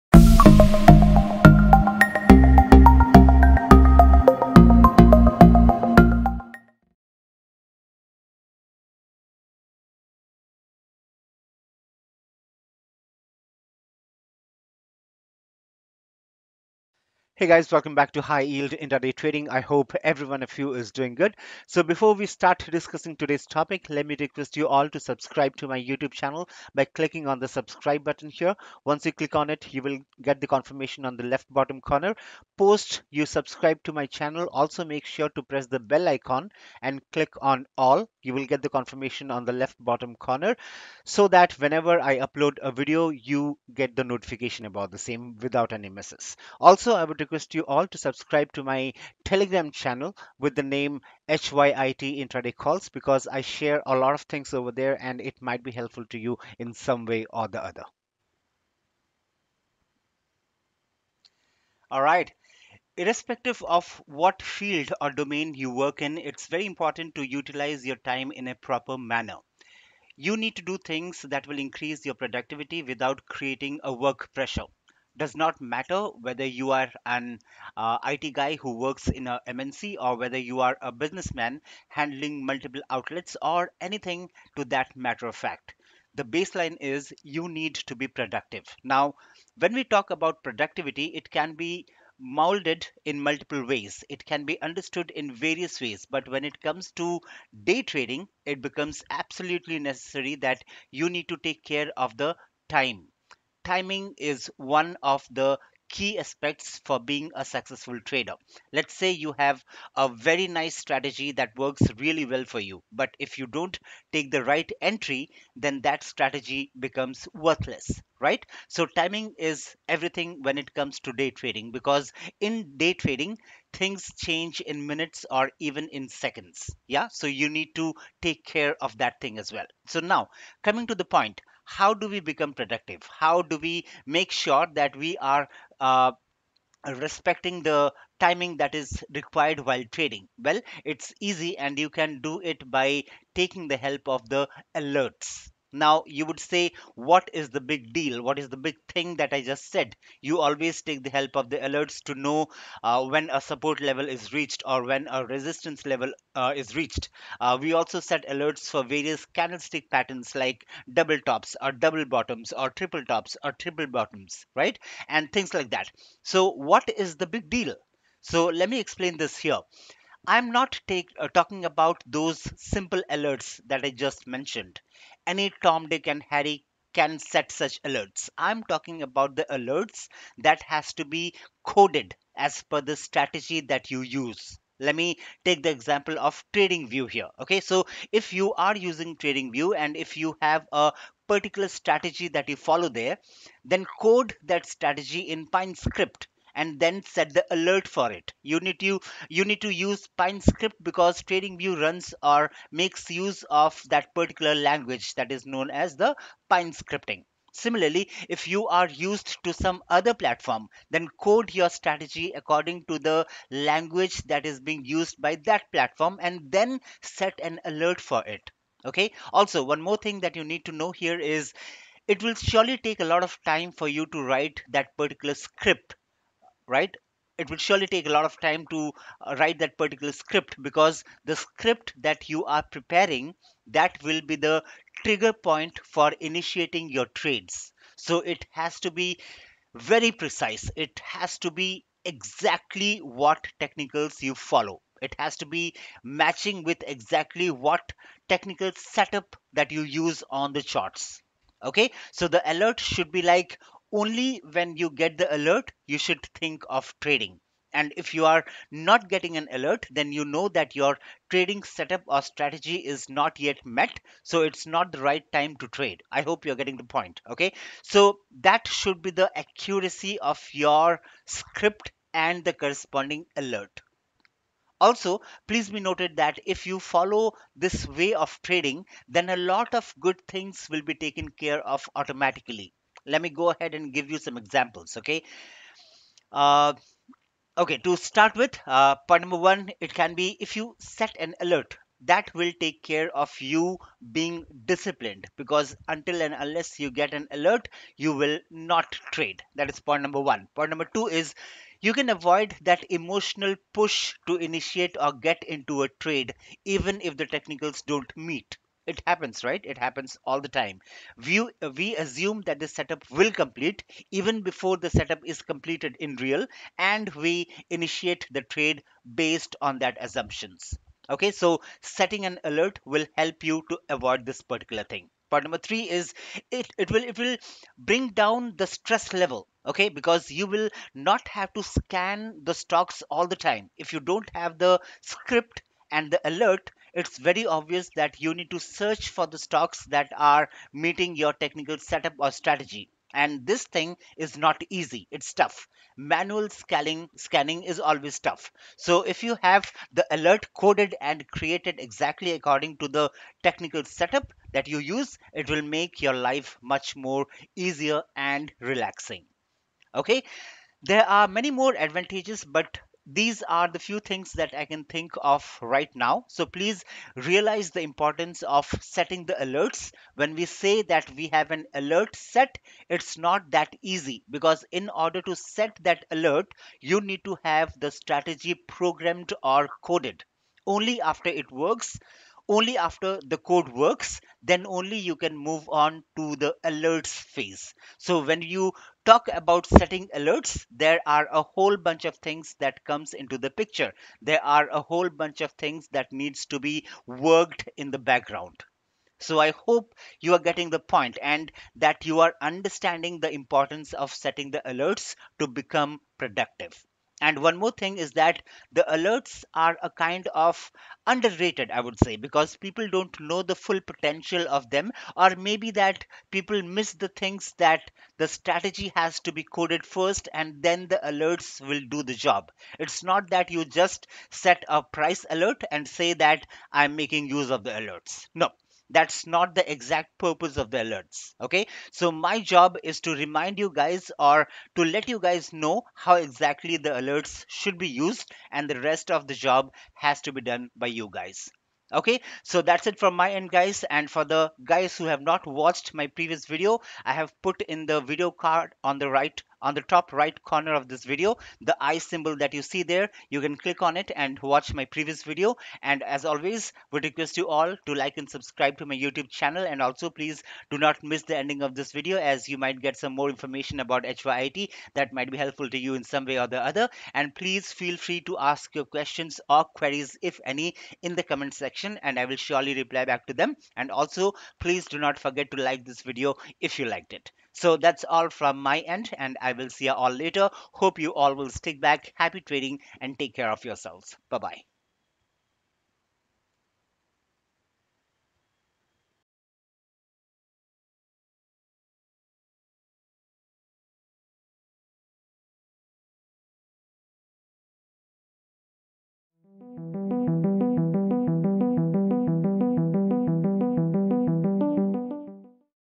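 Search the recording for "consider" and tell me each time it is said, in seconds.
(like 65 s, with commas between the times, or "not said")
not said.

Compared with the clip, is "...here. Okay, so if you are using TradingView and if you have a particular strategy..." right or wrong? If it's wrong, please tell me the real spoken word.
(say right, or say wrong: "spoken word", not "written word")
right.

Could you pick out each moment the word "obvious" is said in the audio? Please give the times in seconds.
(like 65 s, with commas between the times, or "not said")
337 s.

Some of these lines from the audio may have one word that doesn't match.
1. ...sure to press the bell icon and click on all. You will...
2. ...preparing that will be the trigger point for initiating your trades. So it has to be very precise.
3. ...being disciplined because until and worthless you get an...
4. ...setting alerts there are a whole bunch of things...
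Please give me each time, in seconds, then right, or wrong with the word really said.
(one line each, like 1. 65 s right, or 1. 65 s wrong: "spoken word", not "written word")
1. 35 s right
2. 232 s right
3. 294 s wrong: "unless", not "worthless"
4. 389 s right.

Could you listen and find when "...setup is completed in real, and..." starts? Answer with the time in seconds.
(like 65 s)
314 s.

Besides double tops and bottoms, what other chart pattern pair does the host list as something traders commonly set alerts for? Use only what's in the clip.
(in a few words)
triple tops.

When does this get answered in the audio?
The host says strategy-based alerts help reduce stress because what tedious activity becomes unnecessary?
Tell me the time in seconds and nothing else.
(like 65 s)
345 s.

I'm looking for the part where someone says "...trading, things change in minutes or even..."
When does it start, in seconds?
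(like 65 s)
122 s.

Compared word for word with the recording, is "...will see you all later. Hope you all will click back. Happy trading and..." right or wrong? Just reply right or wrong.
wrong.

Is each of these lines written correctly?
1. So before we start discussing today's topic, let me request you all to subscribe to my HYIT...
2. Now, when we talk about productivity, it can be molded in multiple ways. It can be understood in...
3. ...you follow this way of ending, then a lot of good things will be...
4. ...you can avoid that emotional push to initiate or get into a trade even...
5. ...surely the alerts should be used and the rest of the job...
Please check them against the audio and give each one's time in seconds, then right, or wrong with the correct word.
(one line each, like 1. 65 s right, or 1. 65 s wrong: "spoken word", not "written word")
1. 21 s wrong: "YouTube", not "HYIT"
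2. 88 s right
3. 276 s wrong: "trading", not "ending"
4. 301 s right
5. 436 s wrong: "exactly", not "surely".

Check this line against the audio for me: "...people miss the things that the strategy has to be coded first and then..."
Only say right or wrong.
right.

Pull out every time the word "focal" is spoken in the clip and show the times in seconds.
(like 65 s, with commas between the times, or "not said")
not said.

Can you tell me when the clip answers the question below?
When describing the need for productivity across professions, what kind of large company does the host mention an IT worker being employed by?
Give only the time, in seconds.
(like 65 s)
79 s.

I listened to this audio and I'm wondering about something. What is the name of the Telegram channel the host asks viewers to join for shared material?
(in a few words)
HYIT Intraday Calls.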